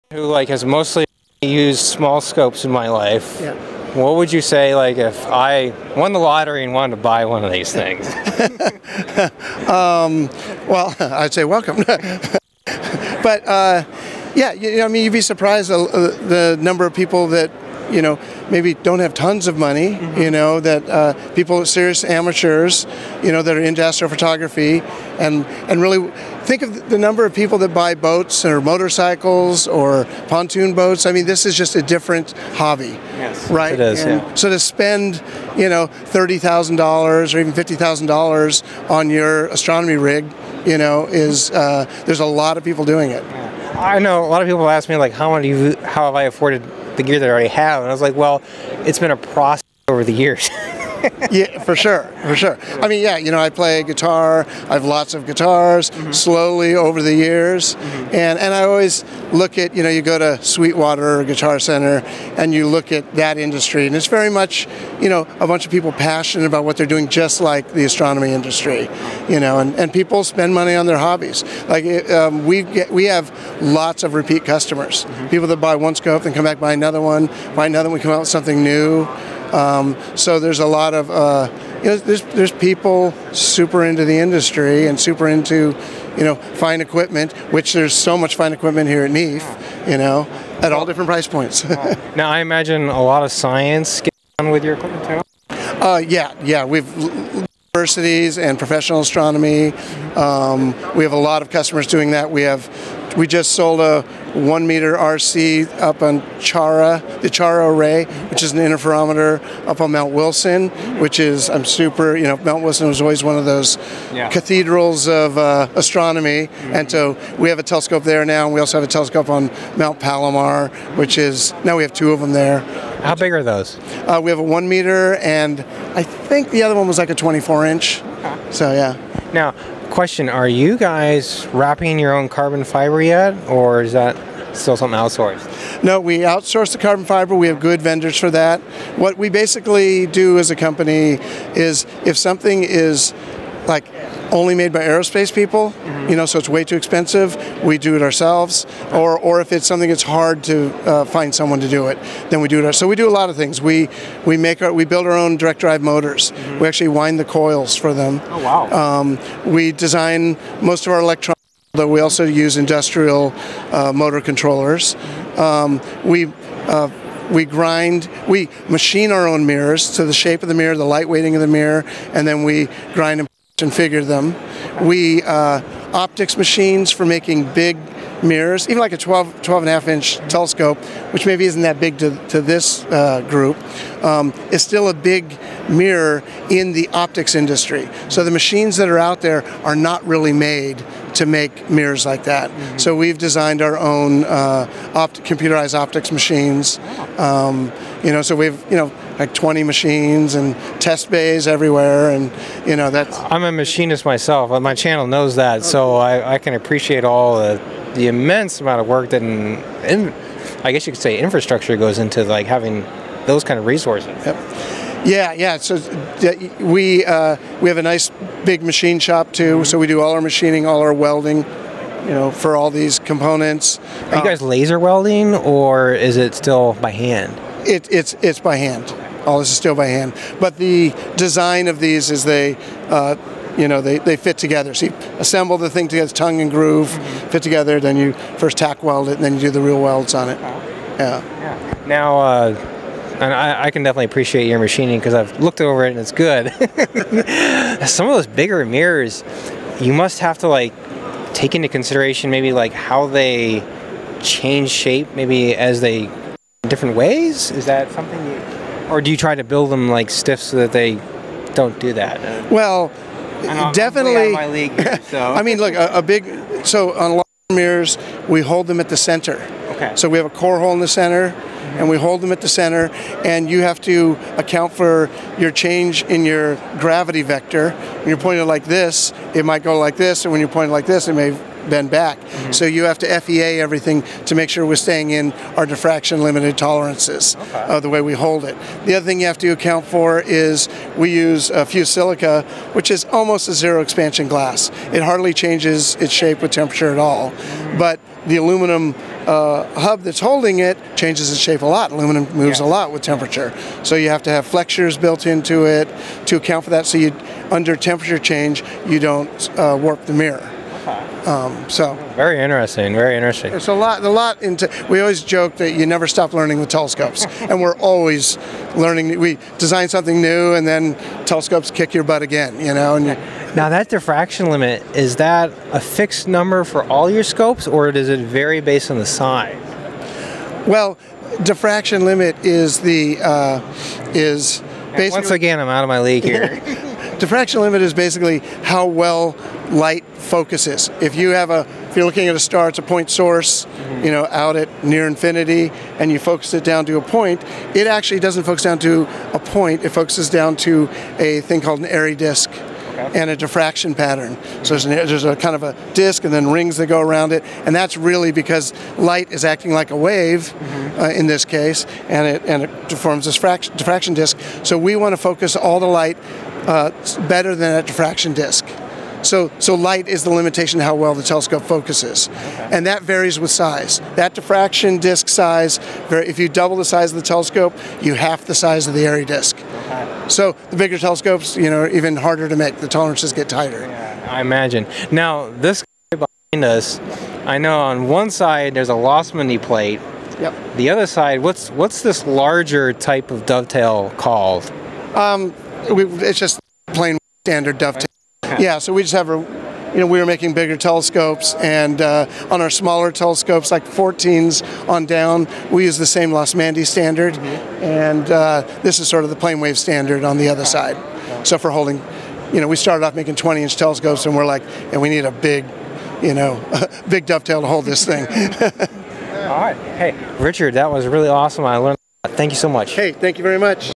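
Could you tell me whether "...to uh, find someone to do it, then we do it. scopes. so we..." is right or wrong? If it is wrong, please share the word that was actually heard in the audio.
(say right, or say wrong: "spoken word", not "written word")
wrong: "ourselves", not "scopes".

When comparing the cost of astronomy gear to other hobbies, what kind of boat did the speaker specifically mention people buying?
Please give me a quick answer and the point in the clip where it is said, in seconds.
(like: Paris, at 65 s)
pontoon boats, at 30 s.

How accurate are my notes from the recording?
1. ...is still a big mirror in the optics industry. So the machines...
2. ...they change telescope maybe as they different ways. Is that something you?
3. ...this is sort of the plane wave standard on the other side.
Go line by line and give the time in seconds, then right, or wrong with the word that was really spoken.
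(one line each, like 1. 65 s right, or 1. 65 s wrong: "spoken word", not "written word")
1. 184 s right
2. 253 s wrong: "shape", not "telescope"
3. 408 s right.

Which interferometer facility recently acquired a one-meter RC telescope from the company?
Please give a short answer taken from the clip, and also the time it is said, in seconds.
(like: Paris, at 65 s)
Chara array, at 107 s.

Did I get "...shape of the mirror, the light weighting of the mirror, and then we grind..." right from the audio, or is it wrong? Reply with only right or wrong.
right.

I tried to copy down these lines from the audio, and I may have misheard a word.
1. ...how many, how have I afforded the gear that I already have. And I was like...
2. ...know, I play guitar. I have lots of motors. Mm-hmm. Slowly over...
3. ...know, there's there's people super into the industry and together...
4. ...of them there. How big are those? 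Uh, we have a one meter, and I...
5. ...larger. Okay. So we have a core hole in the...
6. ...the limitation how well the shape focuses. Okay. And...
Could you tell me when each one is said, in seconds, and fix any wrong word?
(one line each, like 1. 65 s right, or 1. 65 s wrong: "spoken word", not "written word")
1. 45 s right
2. 53 s wrong: "guitars", not "motors"
3. 81 s wrong: "super", not "together"
4. 122 s right
5. 268 s wrong: "center", not "larger"
6. 370 s wrong: "telescope", not "shape".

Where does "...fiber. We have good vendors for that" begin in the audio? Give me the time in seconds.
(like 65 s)
137 s.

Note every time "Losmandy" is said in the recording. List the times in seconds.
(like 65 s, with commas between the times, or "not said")
388 s, 406 s.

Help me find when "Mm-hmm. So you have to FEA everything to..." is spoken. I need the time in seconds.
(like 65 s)
282 s.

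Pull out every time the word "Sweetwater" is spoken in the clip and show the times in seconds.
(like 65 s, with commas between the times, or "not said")
60 s.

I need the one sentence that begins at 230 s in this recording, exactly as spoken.
But the design of these is they, uh, you know, they, they fit together.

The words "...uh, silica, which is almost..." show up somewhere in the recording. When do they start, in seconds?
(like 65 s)
291 s.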